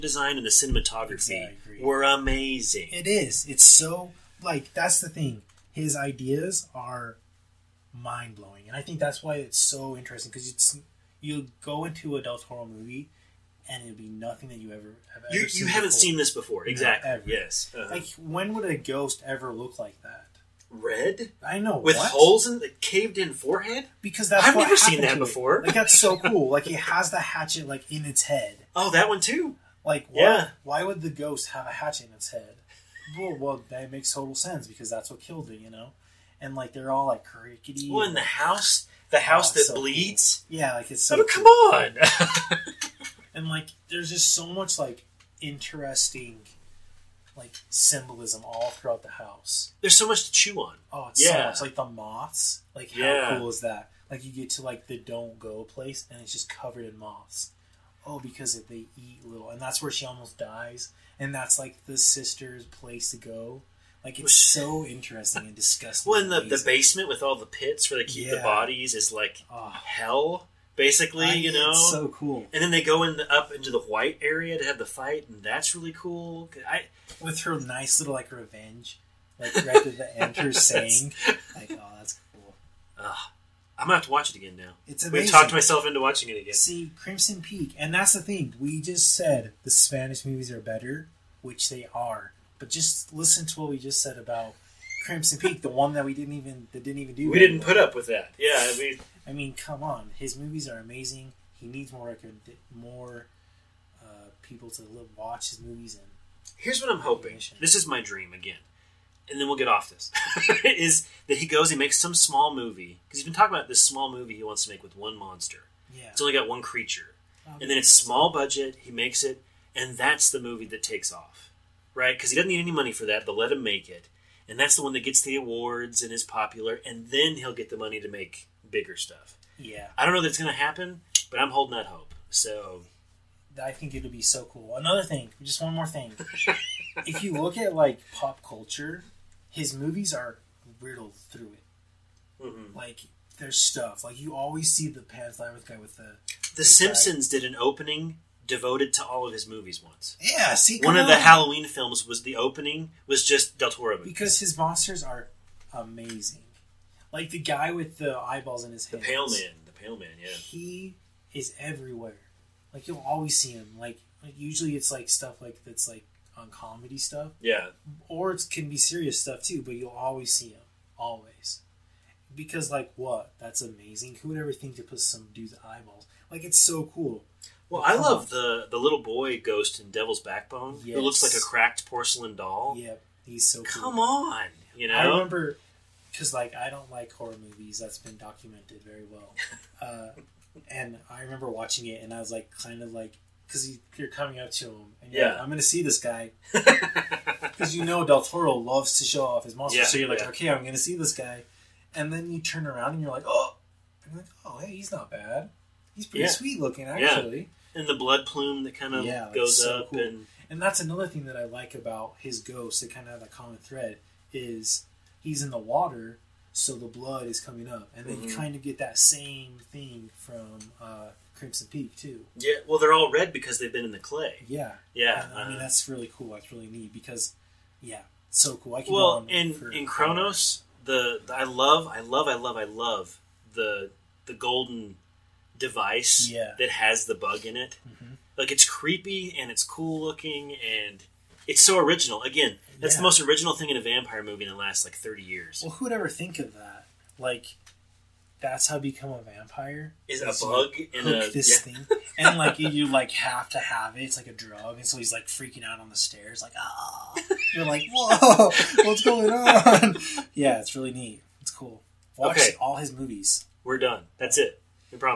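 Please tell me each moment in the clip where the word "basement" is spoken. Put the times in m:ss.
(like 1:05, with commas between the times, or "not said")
1:06.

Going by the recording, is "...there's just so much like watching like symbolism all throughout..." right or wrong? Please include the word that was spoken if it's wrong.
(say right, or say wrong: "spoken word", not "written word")
wrong: "interesting", not "watching".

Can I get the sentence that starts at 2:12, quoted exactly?
So I think it'll be so cool.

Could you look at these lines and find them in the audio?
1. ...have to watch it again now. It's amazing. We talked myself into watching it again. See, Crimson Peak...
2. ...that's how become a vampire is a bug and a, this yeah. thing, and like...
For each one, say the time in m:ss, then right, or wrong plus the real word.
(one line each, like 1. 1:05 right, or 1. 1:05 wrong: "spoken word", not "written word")
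1. 1:23 right
2. 4:08 right.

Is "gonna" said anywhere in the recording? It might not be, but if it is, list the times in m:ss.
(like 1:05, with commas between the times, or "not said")
1:23, 3:15, 3:20.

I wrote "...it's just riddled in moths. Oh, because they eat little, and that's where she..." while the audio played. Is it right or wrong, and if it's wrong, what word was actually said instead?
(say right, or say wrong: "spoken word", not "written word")
wrong: "covered", not "riddled".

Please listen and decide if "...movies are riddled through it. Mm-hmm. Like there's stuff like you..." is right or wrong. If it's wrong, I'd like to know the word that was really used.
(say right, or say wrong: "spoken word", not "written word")
right.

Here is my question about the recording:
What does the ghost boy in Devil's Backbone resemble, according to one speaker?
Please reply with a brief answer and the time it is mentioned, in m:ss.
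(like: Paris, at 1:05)
A cracked porcelain doll, at 3:01.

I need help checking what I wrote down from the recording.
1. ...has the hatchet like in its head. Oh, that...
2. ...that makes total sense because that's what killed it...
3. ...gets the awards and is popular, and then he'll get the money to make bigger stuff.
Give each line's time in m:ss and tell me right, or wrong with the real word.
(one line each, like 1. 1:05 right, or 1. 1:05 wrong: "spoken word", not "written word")
1. 0:26 right
2. 0:33 right
3. 2:05 right.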